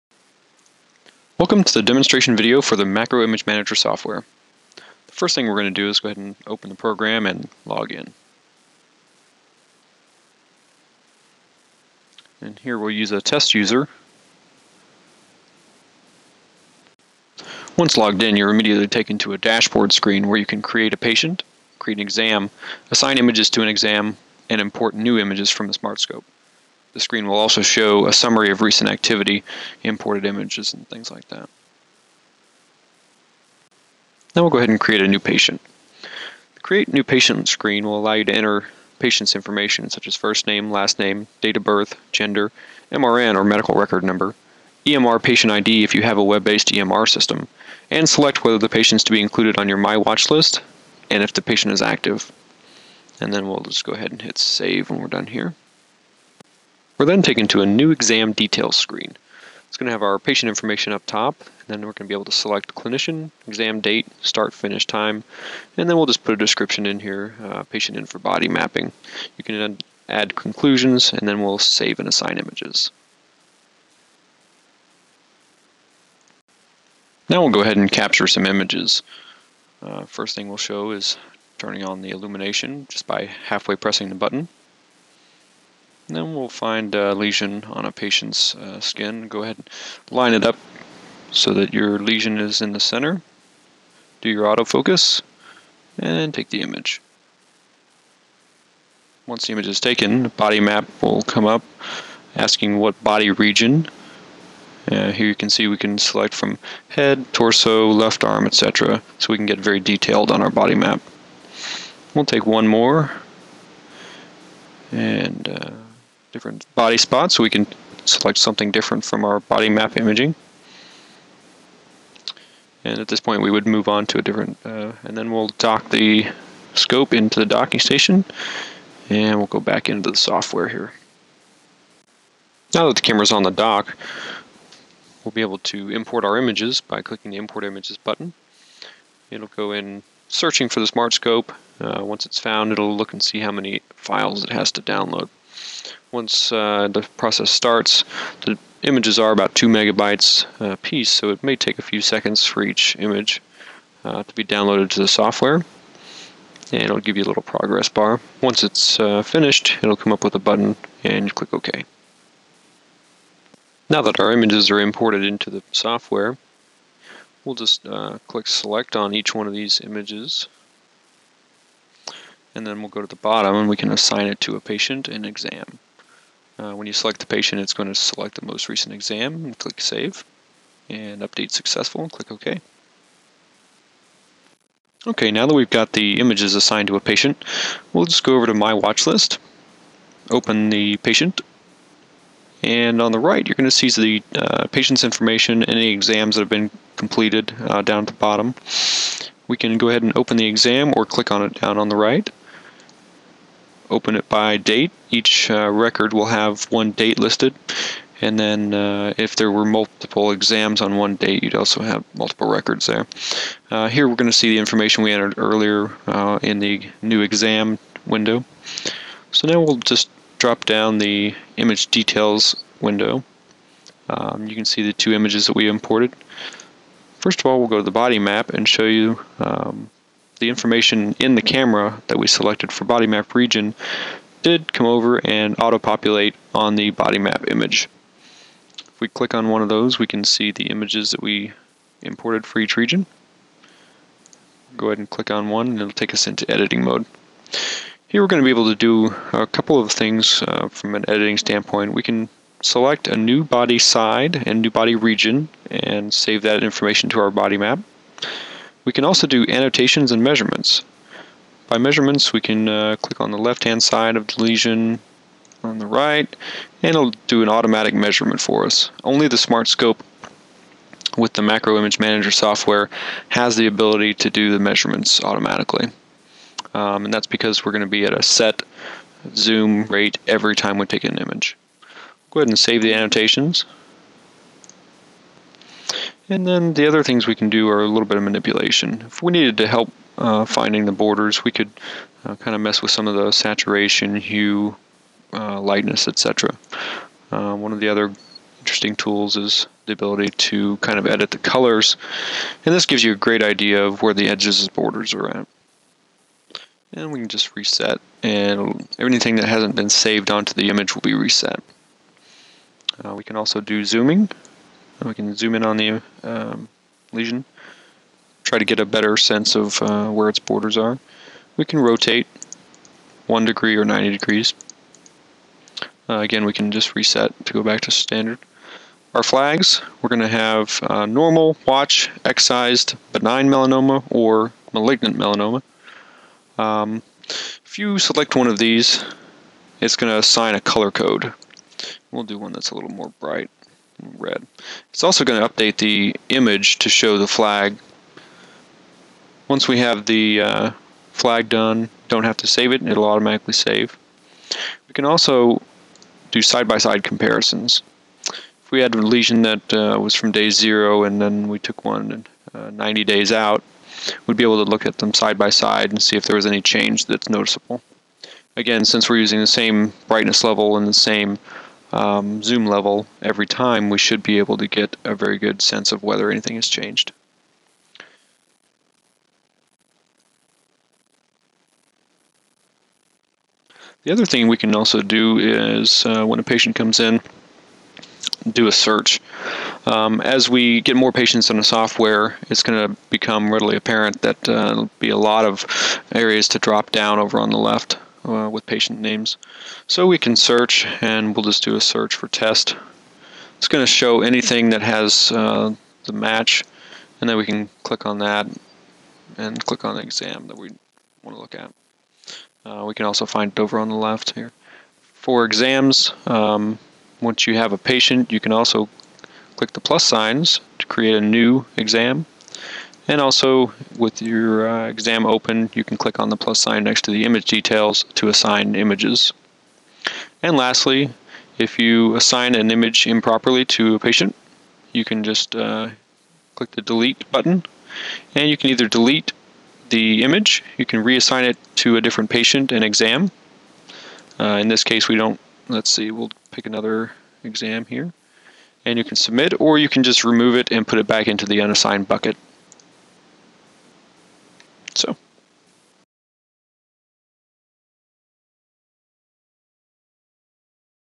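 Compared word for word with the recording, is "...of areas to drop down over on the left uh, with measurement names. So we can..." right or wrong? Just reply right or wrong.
wrong.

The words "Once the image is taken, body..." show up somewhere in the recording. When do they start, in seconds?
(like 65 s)
99 s.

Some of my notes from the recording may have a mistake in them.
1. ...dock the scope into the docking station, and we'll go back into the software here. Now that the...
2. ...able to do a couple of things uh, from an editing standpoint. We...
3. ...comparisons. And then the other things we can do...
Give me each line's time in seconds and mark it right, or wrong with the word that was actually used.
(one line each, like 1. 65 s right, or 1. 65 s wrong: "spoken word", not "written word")
1. 125 s right
2. 248 s right
3. 282 s wrong: "annotations", not "comparisons".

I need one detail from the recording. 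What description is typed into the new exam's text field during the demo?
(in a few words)
patient in for body mapping.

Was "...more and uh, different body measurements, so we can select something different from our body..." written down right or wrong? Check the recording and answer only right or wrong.
wrong.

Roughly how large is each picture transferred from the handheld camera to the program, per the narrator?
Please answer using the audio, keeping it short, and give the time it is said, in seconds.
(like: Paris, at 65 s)
2 megabytes, at 149 s.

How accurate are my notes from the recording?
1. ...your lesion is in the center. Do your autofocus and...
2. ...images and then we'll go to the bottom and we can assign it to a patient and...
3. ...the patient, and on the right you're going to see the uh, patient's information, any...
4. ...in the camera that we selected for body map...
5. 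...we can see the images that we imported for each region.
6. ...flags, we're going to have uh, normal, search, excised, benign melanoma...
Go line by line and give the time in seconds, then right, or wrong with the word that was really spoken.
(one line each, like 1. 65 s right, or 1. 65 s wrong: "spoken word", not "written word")
1. 91 s right
2. 169 s right
3. 190 s right
4. 231 s right
5. 239 s right
6. 329 s wrong: "watch", not "search".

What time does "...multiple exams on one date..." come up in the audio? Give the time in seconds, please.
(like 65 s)
209 s.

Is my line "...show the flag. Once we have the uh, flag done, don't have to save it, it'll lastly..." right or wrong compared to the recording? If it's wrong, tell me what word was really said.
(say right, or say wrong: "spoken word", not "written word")
wrong: "automatically", not "lastly".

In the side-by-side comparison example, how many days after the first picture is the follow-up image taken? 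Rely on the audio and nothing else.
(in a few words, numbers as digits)
90 days.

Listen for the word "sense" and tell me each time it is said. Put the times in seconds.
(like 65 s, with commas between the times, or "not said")
319 s, 375 s.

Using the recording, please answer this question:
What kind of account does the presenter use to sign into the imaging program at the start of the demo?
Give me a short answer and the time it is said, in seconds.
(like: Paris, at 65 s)
test user, at 13 s.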